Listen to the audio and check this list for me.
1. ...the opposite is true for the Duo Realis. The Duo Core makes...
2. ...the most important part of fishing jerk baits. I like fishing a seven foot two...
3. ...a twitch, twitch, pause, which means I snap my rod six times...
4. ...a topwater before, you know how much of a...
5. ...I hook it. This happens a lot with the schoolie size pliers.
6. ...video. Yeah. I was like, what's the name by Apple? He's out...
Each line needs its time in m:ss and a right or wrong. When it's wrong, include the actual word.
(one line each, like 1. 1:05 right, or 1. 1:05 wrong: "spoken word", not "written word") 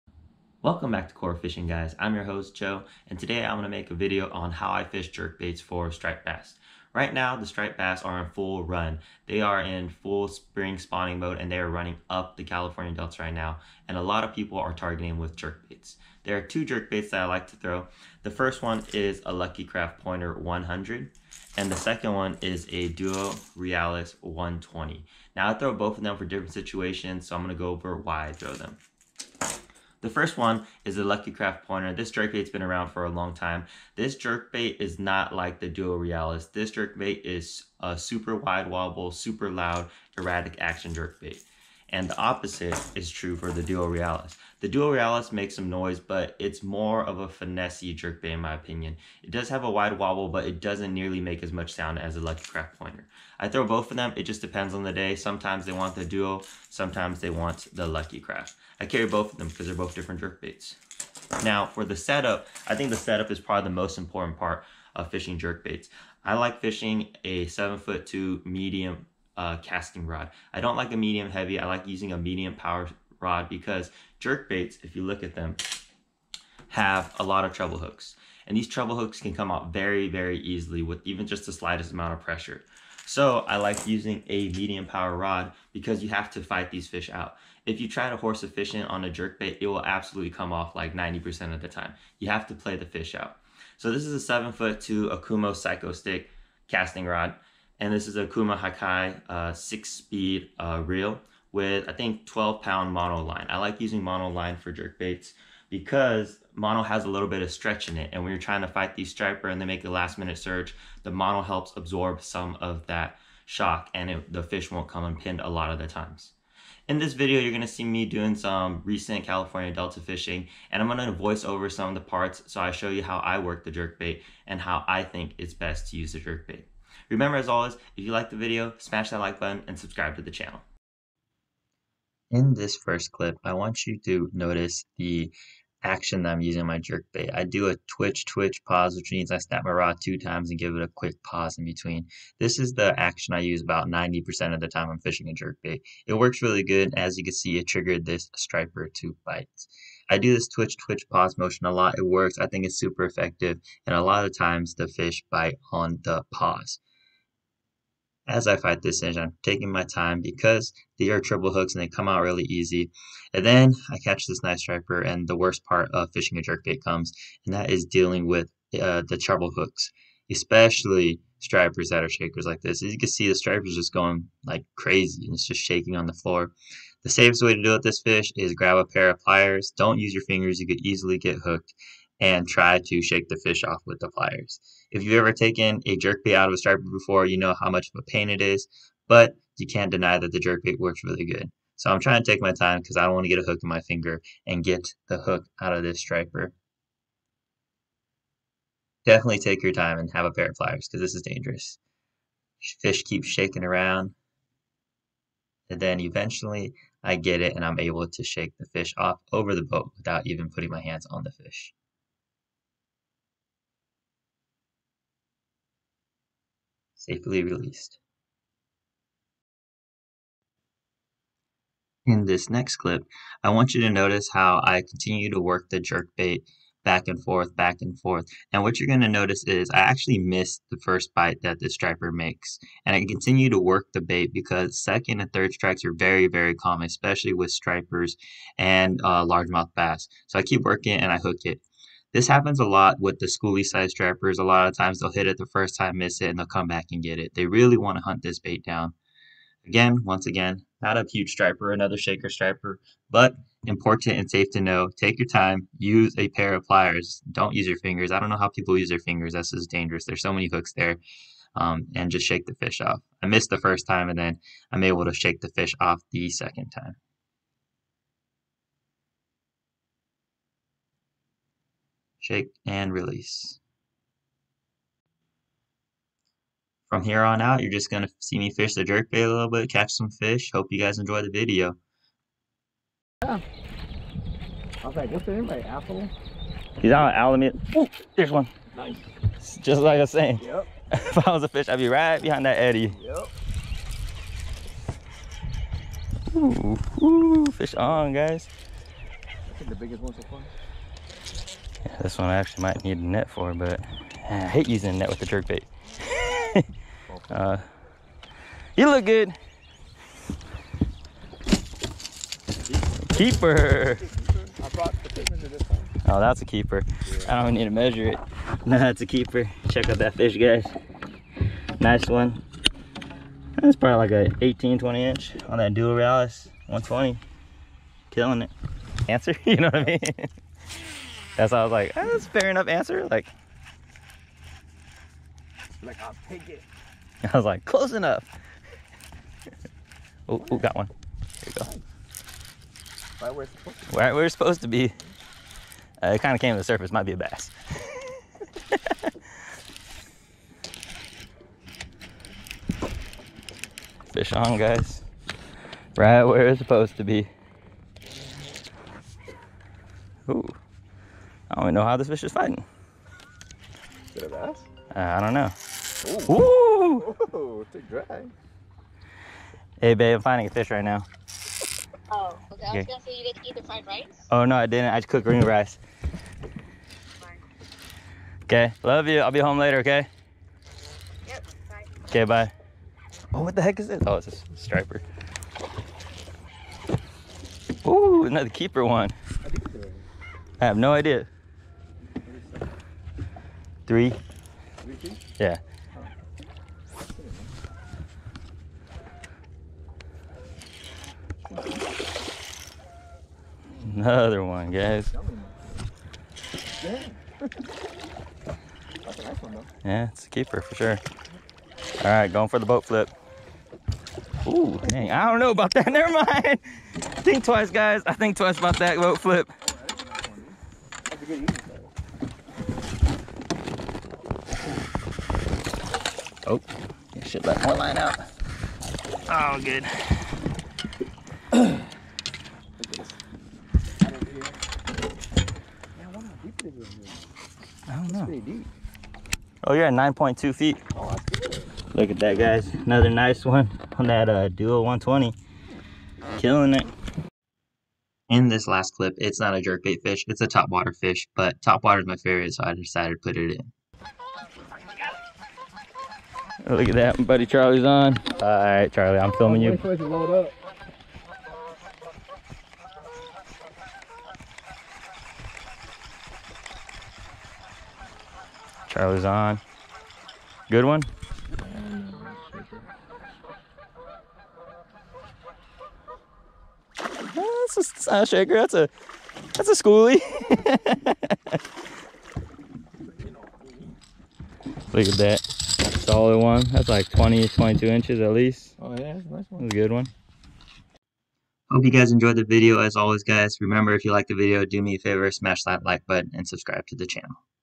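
1. 0:42 wrong: "Realis", not "Core"
2. 1:03 right
3. 2:17 wrong: "two", not "six"
4. 3:06 wrong: "striper", not "topwater"
5. 4:01 wrong: "stripers", not "pliers"
6. 4:41 right.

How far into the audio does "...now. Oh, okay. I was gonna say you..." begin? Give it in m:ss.
6:10.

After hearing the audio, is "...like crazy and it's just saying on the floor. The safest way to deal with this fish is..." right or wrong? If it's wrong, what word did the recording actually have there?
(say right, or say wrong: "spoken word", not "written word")
wrong: "shaking", not "saying".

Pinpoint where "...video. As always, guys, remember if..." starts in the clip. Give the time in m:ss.
8:12.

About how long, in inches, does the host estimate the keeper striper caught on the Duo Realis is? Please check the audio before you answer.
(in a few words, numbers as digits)
18 to 20 inches.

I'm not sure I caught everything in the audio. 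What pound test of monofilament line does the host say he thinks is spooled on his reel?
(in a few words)
12 pound.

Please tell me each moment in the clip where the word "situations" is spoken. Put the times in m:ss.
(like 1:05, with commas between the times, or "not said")
0:26.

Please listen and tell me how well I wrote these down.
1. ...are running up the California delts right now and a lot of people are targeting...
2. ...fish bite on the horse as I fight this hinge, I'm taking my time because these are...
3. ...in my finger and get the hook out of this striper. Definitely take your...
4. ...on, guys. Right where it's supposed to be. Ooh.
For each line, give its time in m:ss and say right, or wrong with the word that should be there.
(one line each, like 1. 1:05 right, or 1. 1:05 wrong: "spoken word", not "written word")
1. 0:11 right
2. 2:34 wrong: "pause", not "horse"
3. 3:13 right
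4. 5:54 right.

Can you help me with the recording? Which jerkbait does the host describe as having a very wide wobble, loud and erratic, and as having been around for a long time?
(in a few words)
Lucky Craft Pointer 100.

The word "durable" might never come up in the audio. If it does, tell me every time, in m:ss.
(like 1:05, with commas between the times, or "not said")
not said.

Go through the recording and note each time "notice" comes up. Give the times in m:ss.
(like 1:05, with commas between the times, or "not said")
2:14, 3:43, 3:49.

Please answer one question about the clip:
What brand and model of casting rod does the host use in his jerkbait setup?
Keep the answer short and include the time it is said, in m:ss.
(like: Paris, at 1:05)
Okuma Psycho Stick, at 1:35.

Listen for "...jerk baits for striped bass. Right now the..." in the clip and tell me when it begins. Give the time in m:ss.
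0:05.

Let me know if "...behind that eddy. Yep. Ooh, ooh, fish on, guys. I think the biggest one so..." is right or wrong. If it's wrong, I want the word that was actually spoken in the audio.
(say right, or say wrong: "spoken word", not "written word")
right.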